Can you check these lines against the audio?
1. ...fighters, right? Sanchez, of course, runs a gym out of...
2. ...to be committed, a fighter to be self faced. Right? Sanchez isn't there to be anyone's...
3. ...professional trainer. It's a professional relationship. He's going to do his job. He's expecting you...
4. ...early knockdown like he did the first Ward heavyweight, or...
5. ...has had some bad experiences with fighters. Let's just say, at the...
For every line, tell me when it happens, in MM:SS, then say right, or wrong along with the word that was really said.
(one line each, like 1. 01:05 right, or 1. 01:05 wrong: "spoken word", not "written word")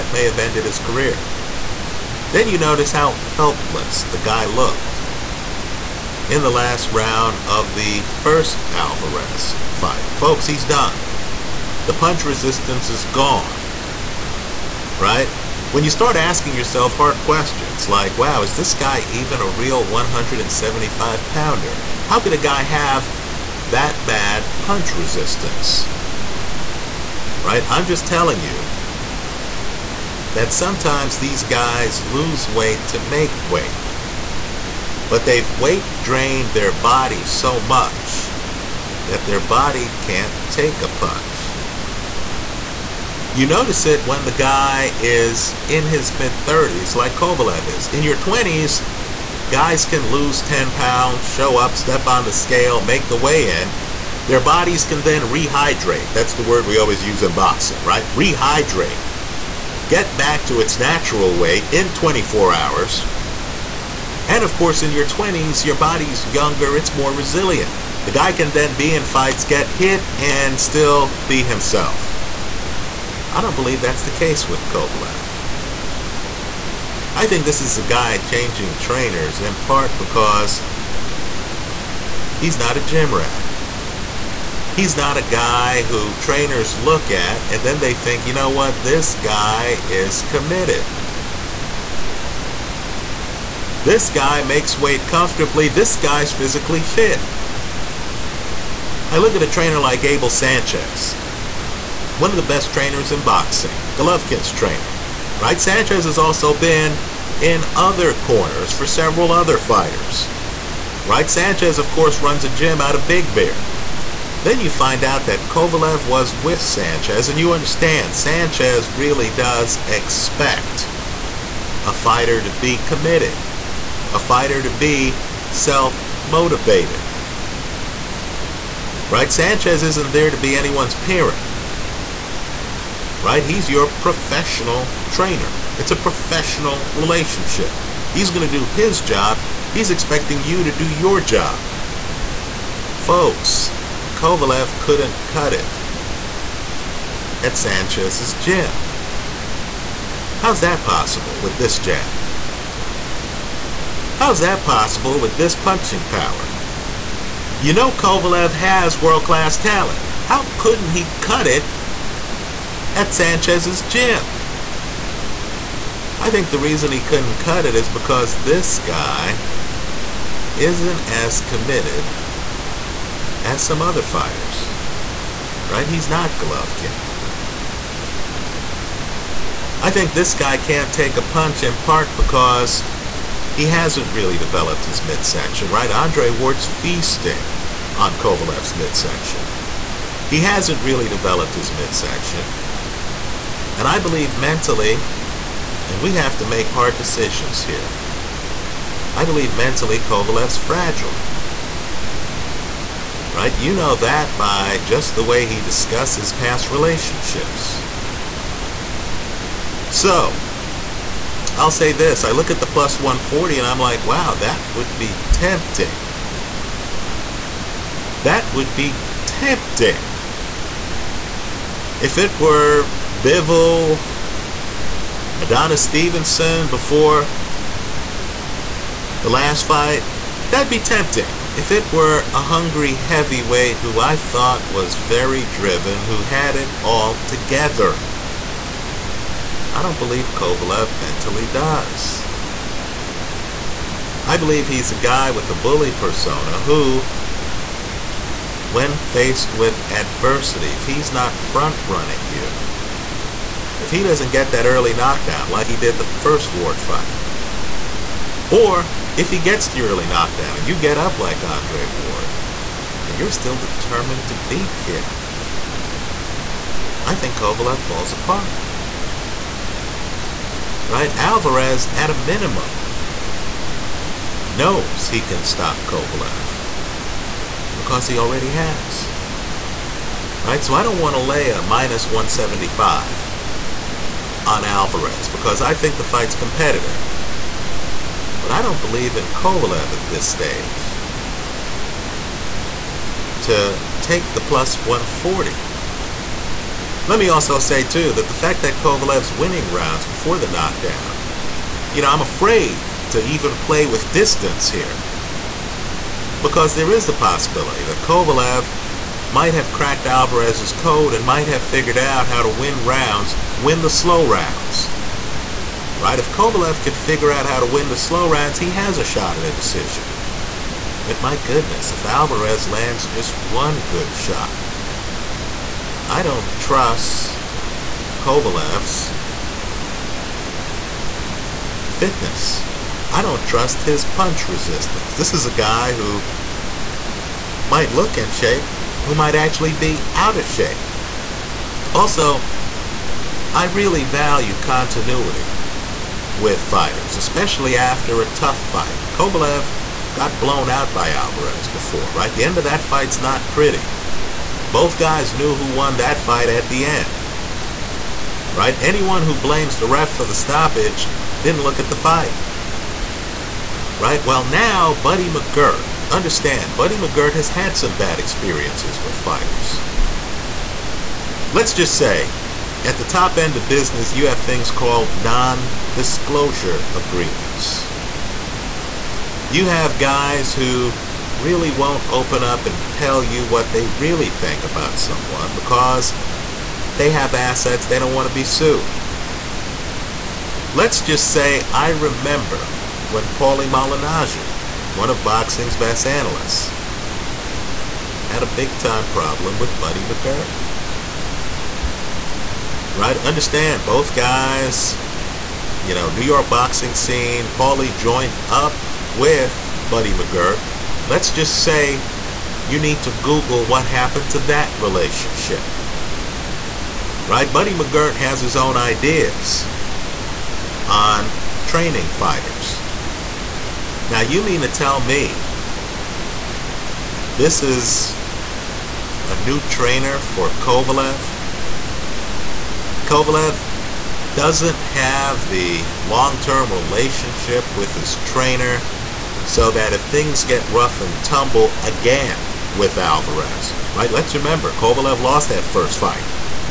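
1. 01:49 right
2. 02:02 wrong: "motivated", not "faced"
3. 02:13 right
4. 04:14 wrong: "fight", not "heavyweight"
5. 06:07 right.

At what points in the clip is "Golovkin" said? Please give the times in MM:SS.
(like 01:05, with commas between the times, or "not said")
01:43, 02:56.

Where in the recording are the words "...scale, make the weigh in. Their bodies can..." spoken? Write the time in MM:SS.
00:52.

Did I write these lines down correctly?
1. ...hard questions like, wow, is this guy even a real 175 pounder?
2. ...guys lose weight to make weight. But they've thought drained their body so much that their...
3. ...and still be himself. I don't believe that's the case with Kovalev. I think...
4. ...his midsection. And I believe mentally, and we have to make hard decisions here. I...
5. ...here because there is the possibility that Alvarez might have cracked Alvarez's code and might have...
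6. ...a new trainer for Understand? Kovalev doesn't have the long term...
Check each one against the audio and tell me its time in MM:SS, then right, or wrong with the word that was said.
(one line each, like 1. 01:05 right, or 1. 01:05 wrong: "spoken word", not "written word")
1. 00:16 right
2. 00:31 wrong: "weight", not "thought"
3. 01:10 right
4. 03:11 right
5. 05:04 wrong: "Kovalev", not "Alvarez"
6. 07:09 wrong: "Kovalev", not "Understand".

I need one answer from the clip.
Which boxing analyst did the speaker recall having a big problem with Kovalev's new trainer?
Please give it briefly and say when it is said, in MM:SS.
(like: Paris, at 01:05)
Paulie Malignaggi, at 06:33.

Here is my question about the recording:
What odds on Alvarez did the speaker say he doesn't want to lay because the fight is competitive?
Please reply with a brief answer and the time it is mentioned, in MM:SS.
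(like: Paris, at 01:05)
-175, at 04:41.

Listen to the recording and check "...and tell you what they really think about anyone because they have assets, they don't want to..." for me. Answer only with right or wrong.
wrong.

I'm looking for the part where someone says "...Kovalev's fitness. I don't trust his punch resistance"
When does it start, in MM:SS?
05:28.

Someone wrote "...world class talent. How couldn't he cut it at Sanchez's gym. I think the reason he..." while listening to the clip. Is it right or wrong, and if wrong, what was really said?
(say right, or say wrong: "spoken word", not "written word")
right.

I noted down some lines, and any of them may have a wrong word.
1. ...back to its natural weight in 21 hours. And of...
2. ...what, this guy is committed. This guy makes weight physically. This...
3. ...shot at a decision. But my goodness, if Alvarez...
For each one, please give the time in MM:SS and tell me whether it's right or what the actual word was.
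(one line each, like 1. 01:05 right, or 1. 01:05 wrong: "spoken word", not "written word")
1. 01:00 wrong: "24", not "21"
2. 01:28 wrong: "comfortably", not "physically"
3. 05:19 right.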